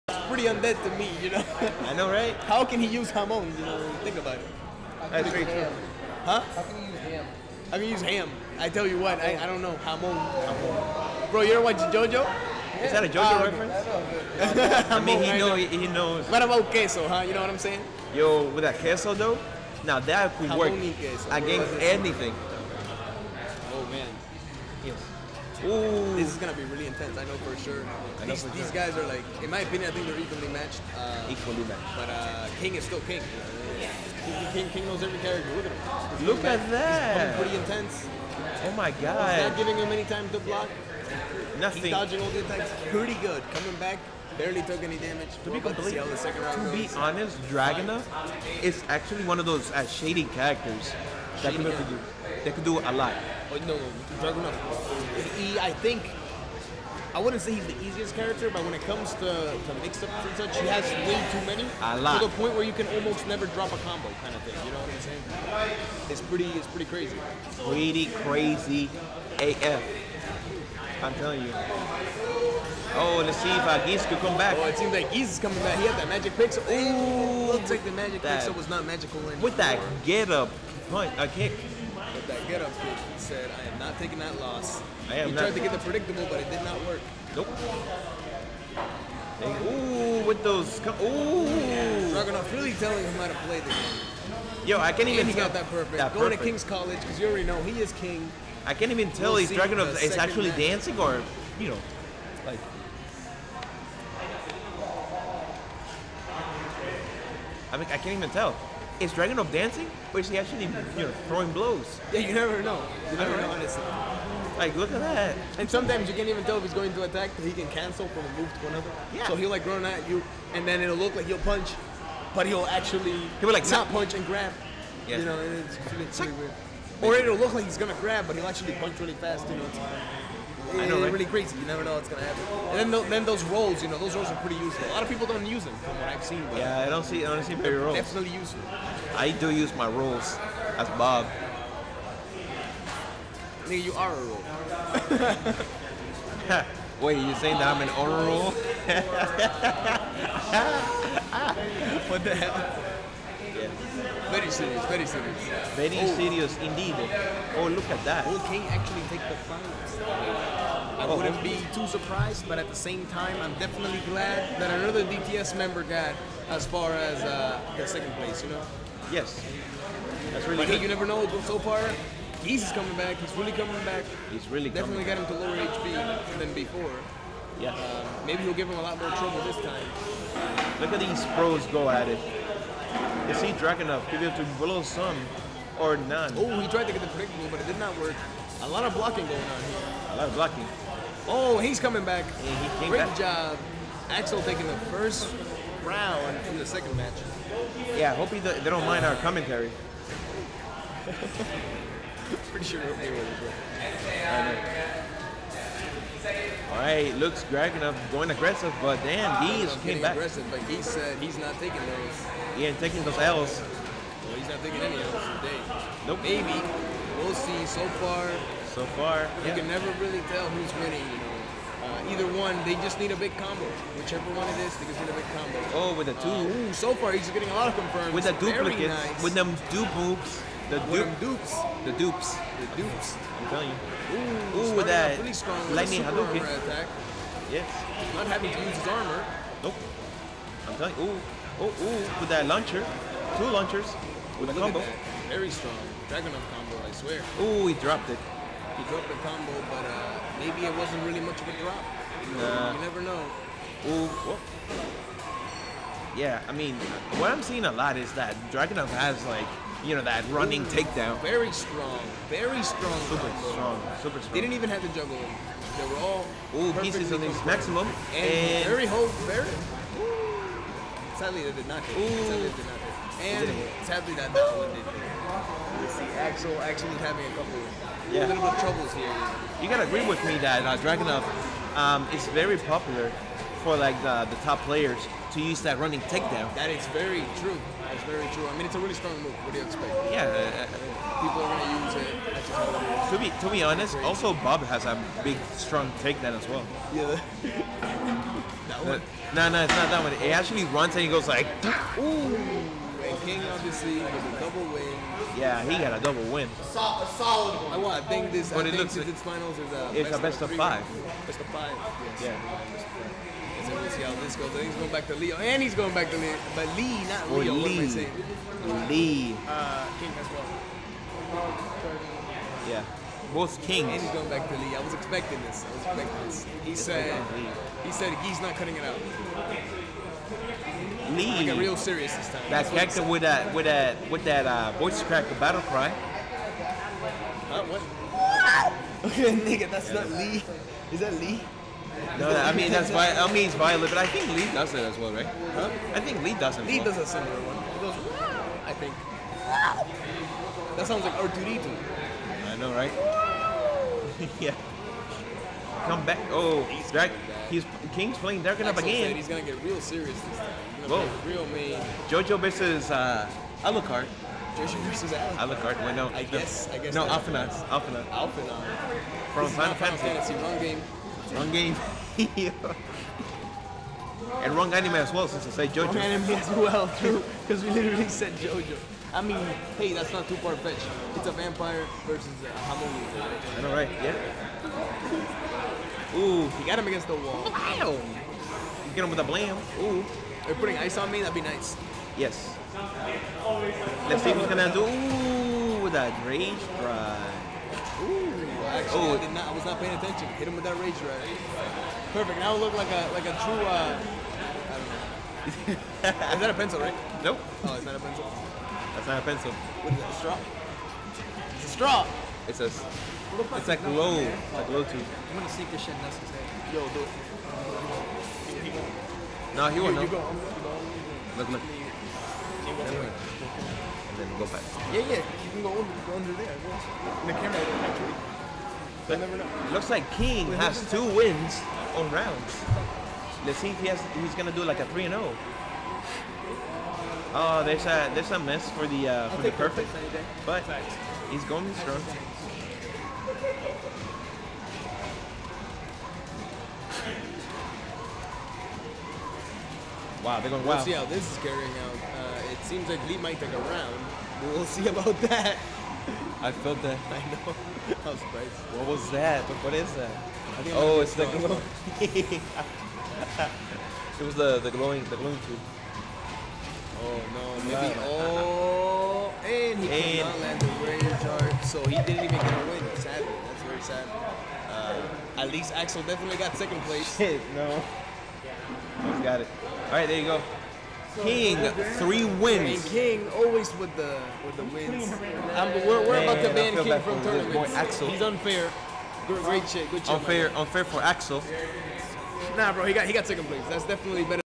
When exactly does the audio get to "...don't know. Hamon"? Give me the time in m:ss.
0:09.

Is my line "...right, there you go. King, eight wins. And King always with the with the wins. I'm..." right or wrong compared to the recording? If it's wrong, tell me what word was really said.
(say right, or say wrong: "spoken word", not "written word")
wrong: "three", not "eight".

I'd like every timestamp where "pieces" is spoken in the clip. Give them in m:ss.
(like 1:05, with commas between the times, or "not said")
4:26.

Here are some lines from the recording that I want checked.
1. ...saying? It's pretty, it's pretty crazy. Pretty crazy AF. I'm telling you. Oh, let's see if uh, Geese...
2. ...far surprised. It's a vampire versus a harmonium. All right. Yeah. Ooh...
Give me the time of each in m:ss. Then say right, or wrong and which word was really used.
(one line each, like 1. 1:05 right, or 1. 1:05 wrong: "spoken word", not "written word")
1. 1:05 right
2. 6:20 wrong: "fetched", not "surprised".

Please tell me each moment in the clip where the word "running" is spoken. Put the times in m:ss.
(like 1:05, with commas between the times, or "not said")
4:20, 4:45.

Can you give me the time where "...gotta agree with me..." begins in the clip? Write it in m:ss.
4:39.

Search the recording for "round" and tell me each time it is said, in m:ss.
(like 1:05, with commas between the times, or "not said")
3:15, 7:12, 7:33.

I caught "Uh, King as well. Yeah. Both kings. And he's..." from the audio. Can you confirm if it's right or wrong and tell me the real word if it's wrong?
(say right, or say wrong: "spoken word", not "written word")
right.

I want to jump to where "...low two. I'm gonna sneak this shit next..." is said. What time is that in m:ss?
6:54.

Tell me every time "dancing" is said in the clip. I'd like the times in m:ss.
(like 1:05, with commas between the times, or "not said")
1:40, 1:49.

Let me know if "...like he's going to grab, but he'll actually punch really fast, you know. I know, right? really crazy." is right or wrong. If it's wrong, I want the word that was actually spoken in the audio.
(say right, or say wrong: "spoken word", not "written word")
right.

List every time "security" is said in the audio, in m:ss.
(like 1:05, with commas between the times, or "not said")
not said.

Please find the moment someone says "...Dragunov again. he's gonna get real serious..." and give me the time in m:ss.
5:58.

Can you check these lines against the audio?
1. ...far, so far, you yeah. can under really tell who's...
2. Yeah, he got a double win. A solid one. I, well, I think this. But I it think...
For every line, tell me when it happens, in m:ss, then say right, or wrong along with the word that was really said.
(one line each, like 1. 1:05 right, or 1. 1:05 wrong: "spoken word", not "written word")
1. 3:37 wrong: "never", not "under"
2. 5:05 right.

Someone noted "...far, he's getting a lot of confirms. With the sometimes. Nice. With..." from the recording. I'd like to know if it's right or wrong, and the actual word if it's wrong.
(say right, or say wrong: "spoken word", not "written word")
wrong: "duplicates", not "sometimes".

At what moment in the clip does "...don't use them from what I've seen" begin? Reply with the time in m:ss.
2:15.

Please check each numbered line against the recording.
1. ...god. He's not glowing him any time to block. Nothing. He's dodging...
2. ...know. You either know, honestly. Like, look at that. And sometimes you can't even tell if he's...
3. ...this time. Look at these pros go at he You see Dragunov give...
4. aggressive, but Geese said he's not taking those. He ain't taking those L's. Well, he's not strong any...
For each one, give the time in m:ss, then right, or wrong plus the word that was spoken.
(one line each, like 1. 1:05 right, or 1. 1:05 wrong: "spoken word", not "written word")
1. 0:38 wrong: "giving", not "glowing"
2. 1:52 wrong: "never", not "either"
3. 2:59 right
4. 3:30 wrong: "taking", not "strong".